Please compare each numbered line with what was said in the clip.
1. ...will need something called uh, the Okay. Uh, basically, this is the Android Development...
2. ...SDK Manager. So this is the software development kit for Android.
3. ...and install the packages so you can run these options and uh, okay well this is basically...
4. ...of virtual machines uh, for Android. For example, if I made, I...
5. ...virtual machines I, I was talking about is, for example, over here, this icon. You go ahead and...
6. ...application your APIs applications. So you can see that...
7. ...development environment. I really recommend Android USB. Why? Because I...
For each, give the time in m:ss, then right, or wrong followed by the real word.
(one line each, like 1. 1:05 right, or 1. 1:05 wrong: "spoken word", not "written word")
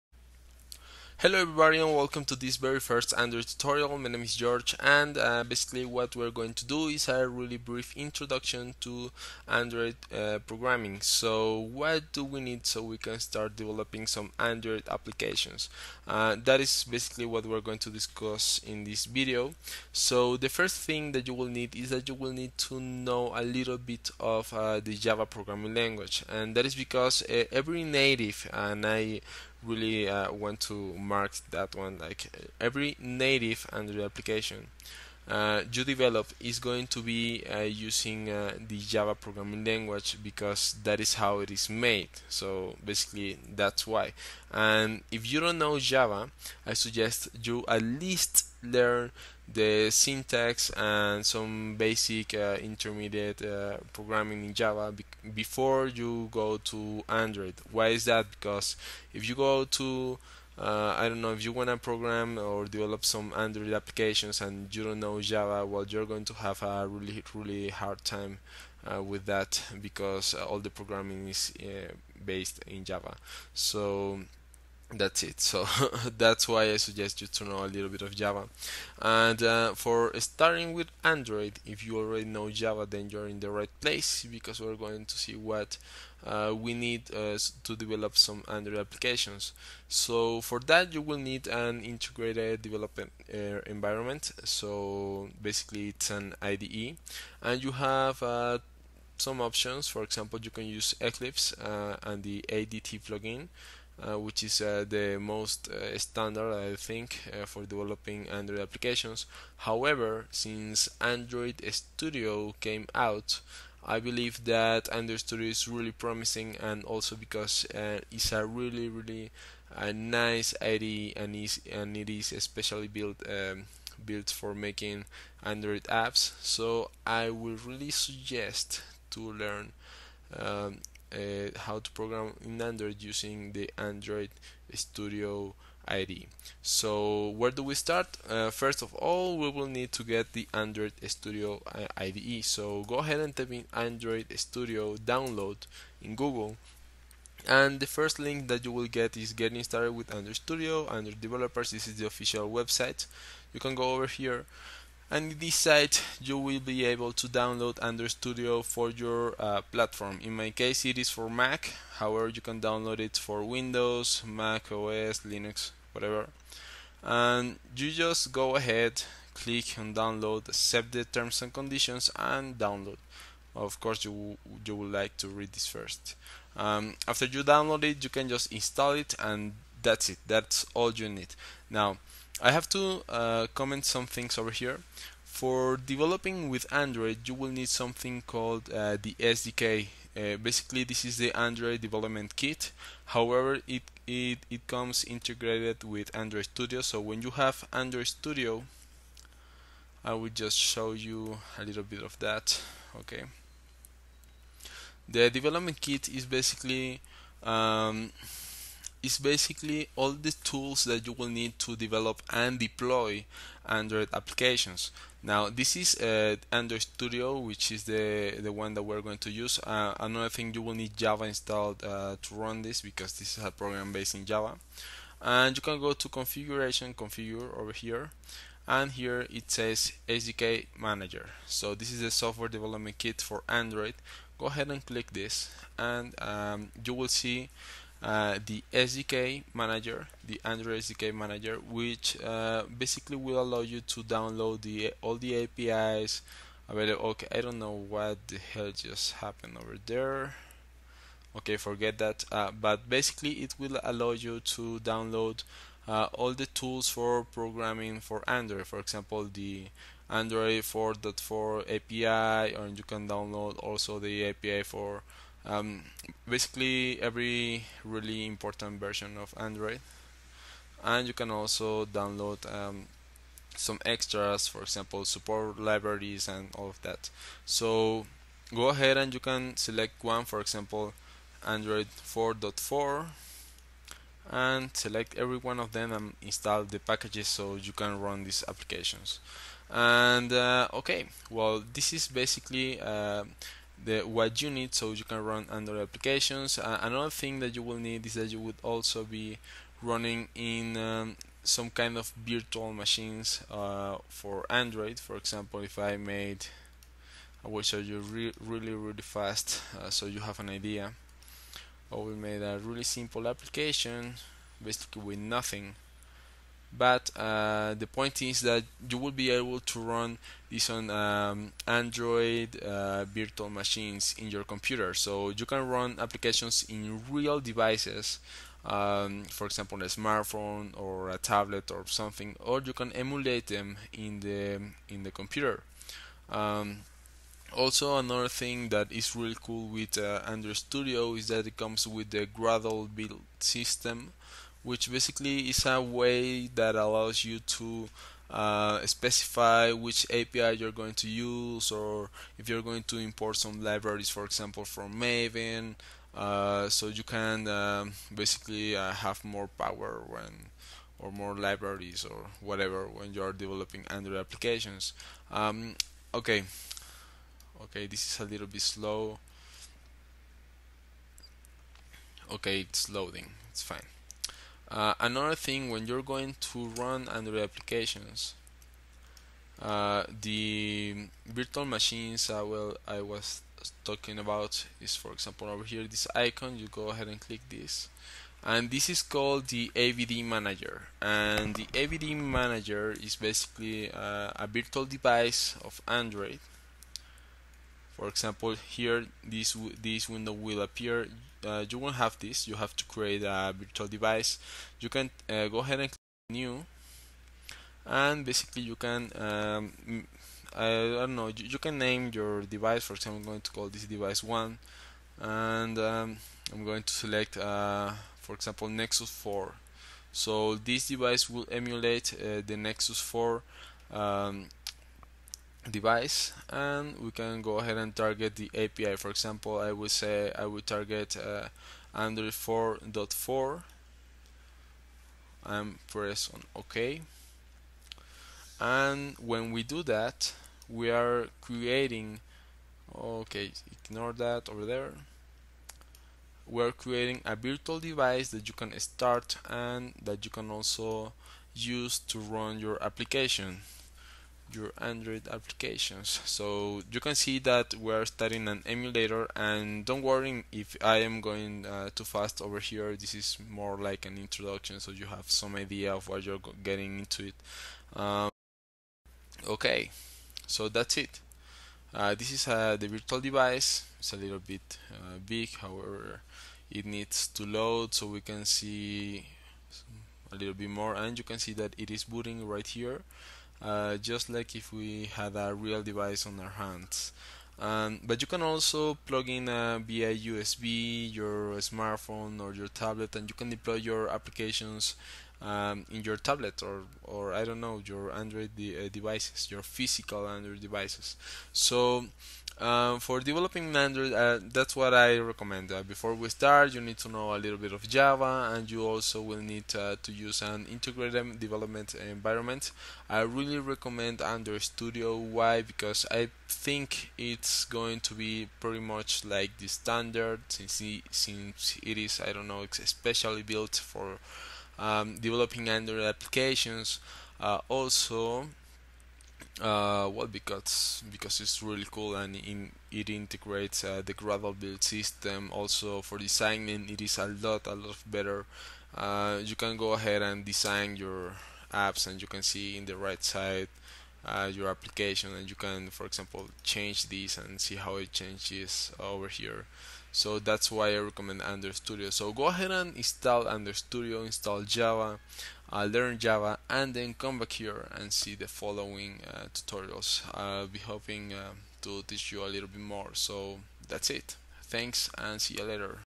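1. 3:07 wrong: "SDK", not "Okay"
2. 3:50 right
3. 4:45 wrong: "applications", not "options"
4. 5:01 right
5. 6:21 right
6. 7:32 wrong: "Android", not "APIs"
7. 8:31 wrong: "Studio", not "USB".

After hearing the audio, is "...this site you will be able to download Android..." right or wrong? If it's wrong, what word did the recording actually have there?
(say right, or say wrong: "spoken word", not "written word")
right.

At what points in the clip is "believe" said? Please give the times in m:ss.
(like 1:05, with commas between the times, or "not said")
1:53.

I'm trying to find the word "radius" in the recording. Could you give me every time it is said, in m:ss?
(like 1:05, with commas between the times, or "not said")
not said.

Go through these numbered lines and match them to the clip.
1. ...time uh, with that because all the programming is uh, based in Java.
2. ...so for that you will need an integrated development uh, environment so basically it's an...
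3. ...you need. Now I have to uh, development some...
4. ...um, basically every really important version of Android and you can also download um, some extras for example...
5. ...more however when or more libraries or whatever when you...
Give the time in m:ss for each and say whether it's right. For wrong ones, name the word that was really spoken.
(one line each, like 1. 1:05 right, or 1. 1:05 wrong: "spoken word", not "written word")
1. 1:08 right
2. 1:29 right
3. 3:00 wrong: "comment", not "development"
4. 4:25 right
5. 5:59 wrong: "power", not "however".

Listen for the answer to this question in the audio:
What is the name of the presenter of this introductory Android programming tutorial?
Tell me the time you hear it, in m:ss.
0:04.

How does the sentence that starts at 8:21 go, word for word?
So um, for developing Android, uh, that's what I recommend.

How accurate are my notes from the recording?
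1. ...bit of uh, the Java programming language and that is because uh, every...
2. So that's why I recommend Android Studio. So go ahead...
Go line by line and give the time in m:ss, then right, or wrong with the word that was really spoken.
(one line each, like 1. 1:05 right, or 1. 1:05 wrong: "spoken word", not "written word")
1. 0:23 right
2. 9:10 right.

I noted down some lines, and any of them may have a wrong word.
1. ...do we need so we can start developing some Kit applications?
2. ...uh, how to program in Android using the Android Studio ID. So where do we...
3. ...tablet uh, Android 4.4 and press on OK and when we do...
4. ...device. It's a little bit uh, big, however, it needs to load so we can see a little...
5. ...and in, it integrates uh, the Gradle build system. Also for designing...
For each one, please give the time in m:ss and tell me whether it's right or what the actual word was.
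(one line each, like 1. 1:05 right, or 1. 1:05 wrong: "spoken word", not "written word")
1. 0:12 wrong: "Android", not "Kit"
2. 2:11 right
3. 7:10 wrong: "target", not "tablet"
4. 7:53 right
5. 8:52 right.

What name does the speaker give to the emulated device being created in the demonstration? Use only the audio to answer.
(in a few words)
device 1.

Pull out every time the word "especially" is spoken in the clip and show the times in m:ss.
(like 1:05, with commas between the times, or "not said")
2:02, 8:42.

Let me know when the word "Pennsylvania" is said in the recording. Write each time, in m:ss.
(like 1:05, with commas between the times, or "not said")
not said.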